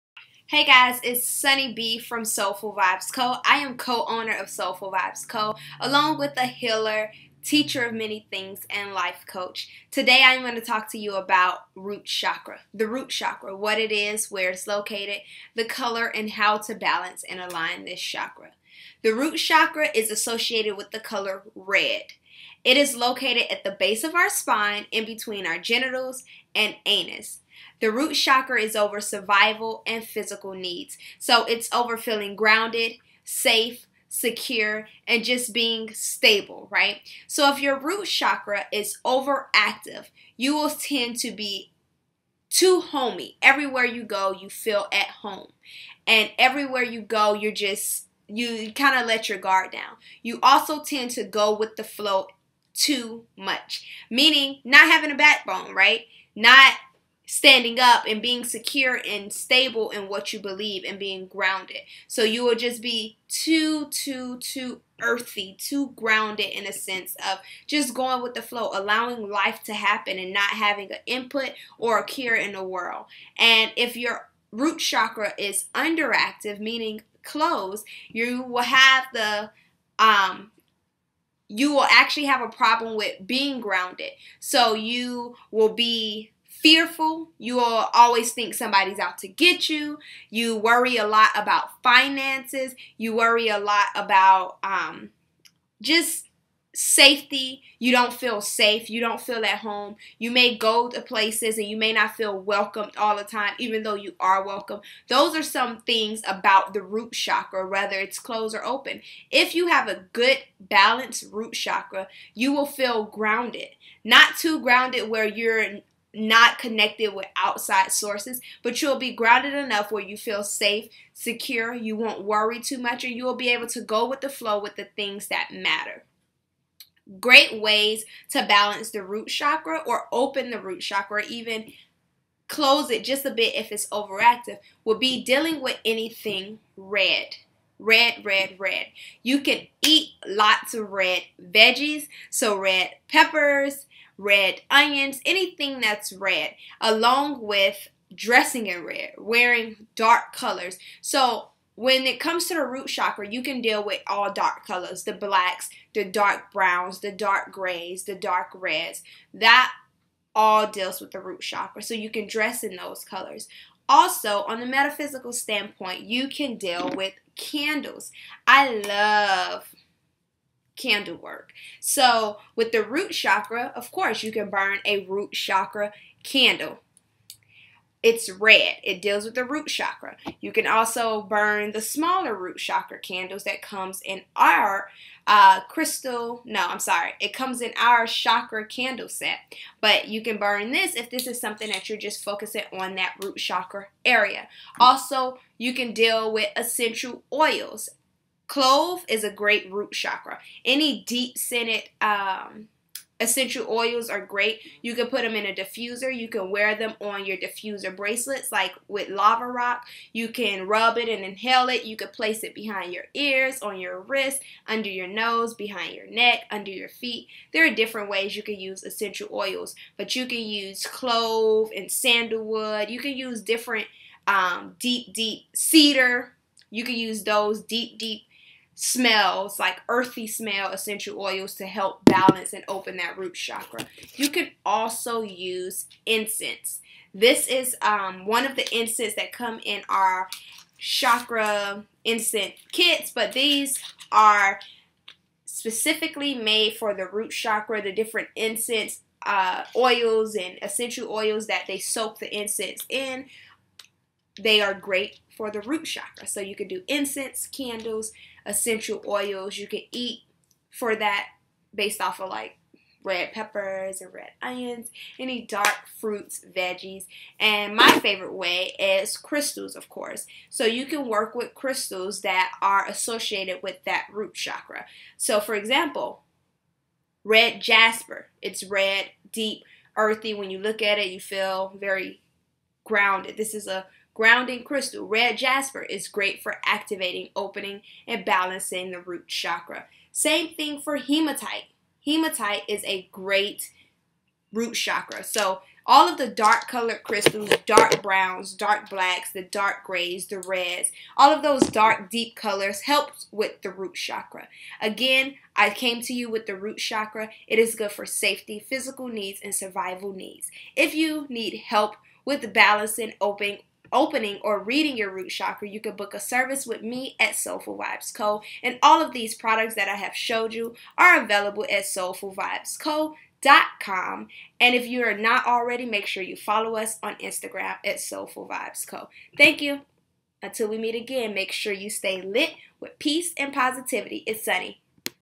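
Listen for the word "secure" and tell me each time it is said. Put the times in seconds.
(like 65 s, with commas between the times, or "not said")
34 s, 58 s, 121 s.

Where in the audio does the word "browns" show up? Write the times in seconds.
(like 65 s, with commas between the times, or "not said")
156 s, 298 s.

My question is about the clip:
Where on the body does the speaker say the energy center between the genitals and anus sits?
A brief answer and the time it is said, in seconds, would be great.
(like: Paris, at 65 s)
Base of our spine, at 23 s.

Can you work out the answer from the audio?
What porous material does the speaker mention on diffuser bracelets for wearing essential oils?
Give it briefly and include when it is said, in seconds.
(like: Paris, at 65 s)
Lava rock, at 209 s.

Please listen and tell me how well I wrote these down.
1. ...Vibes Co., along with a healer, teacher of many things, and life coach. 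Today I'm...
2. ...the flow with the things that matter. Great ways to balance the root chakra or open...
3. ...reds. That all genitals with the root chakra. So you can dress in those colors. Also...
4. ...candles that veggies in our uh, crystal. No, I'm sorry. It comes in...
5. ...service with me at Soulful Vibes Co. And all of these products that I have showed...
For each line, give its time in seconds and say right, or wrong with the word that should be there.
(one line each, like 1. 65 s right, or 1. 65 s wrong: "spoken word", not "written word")
1. 4 s right
2. 124 s right
3. 158 s wrong: "deals", not "genitals"
4. 182 s wrong: "comes", not "veggies"
5. 316 s right.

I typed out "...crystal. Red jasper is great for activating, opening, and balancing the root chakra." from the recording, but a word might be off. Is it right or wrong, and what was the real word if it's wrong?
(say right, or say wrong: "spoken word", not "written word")
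right.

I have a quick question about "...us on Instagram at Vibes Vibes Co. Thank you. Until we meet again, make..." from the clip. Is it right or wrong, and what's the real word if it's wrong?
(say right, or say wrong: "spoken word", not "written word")
wrong: "Soulful", not "Vibes".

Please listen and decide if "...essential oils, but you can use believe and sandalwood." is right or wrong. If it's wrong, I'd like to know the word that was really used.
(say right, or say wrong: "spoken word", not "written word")
wrong: "clove", not "believe".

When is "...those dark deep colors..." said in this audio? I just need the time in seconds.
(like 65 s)
301 s.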